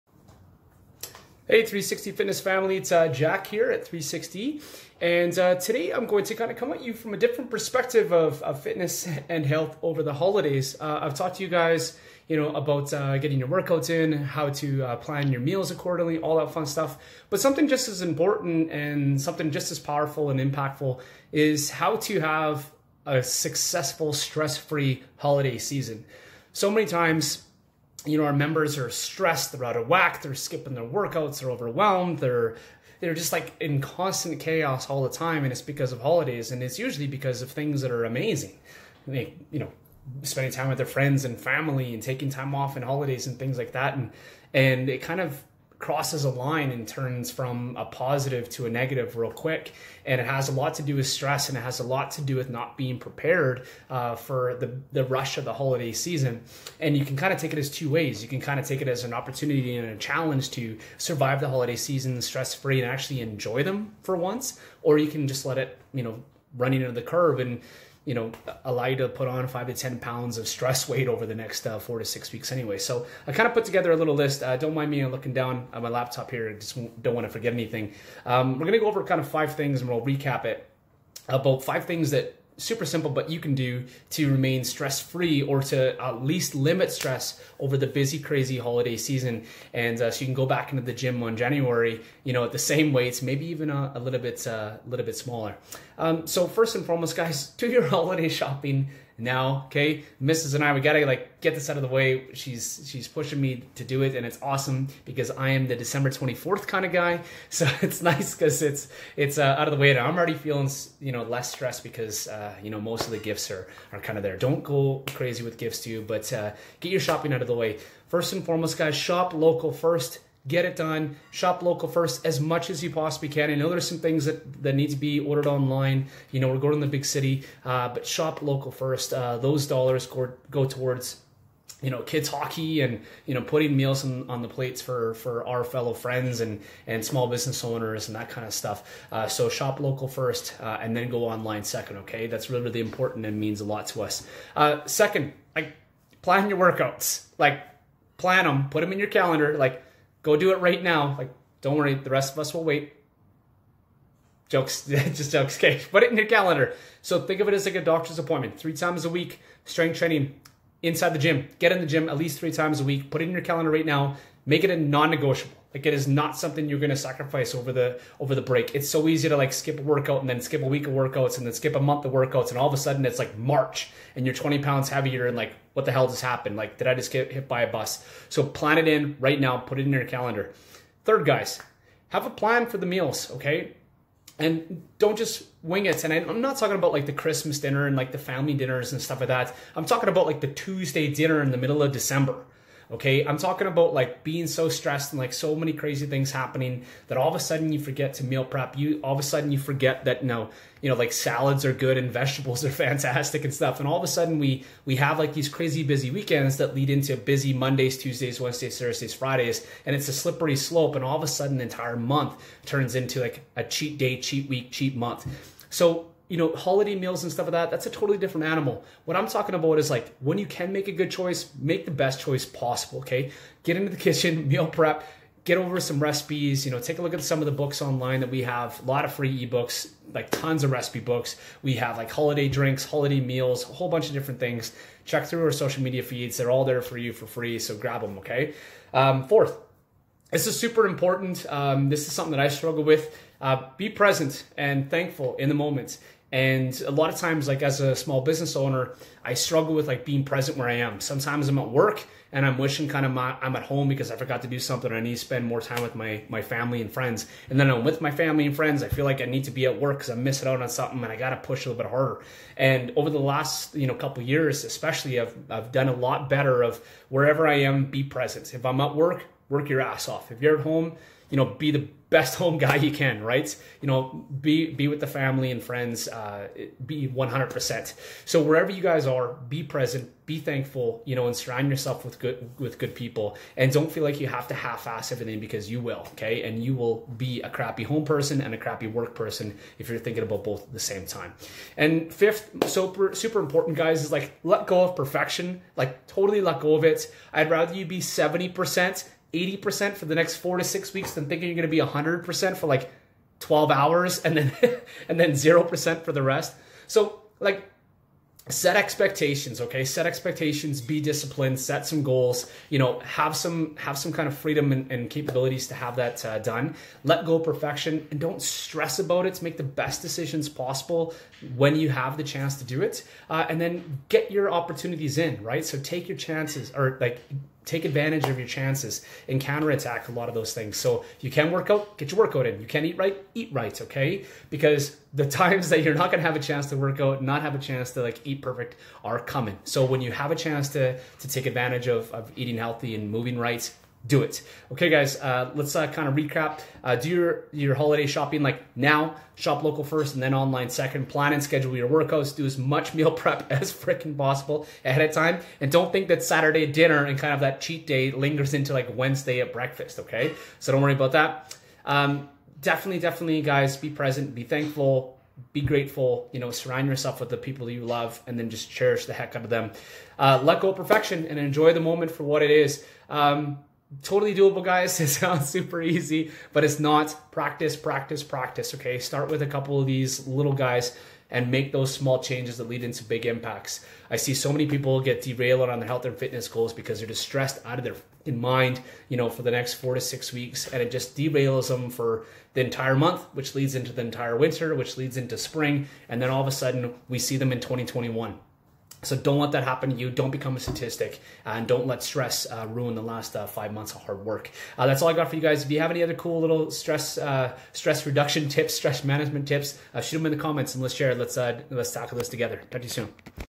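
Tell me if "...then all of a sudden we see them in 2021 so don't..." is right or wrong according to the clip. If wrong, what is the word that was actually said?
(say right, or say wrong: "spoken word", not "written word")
right.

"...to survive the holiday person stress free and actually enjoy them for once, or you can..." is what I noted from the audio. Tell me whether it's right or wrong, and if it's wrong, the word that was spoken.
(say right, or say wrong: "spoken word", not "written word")
wrong: "season", not "person".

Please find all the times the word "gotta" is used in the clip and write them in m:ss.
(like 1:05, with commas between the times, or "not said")
1:40.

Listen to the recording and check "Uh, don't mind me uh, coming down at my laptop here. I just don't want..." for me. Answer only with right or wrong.
wrong.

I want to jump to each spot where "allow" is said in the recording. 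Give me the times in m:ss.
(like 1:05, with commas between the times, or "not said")
1:08.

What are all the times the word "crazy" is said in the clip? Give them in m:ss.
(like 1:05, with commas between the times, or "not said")
1:28, 1:55, 3:15, 3:25.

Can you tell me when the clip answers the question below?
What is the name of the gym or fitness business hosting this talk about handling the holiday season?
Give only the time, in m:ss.
0:01.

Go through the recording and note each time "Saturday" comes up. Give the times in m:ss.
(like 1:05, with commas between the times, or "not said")
5:56.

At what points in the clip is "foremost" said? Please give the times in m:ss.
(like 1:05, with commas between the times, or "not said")
1:36, 1:58.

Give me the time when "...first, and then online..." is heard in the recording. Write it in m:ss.
5:49.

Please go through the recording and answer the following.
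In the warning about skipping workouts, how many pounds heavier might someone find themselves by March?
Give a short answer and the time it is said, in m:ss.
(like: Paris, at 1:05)
20, at 2:54.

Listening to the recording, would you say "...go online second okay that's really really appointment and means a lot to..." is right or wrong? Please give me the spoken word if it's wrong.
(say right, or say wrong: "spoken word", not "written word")
wrong: "important", not "appointment".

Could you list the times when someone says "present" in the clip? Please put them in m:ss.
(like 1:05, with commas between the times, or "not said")
4:03, 4:10, 4:28, 4:39, 6:03.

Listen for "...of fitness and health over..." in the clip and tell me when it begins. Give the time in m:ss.
0:08.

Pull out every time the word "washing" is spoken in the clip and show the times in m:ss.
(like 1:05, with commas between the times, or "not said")
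not said.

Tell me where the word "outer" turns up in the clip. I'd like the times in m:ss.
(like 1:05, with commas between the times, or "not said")
not said.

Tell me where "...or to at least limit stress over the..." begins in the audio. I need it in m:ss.
1:25.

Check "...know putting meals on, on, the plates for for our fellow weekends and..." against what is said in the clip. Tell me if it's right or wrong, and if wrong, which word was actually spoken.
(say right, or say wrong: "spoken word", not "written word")
wrong: "friends", not "weekends".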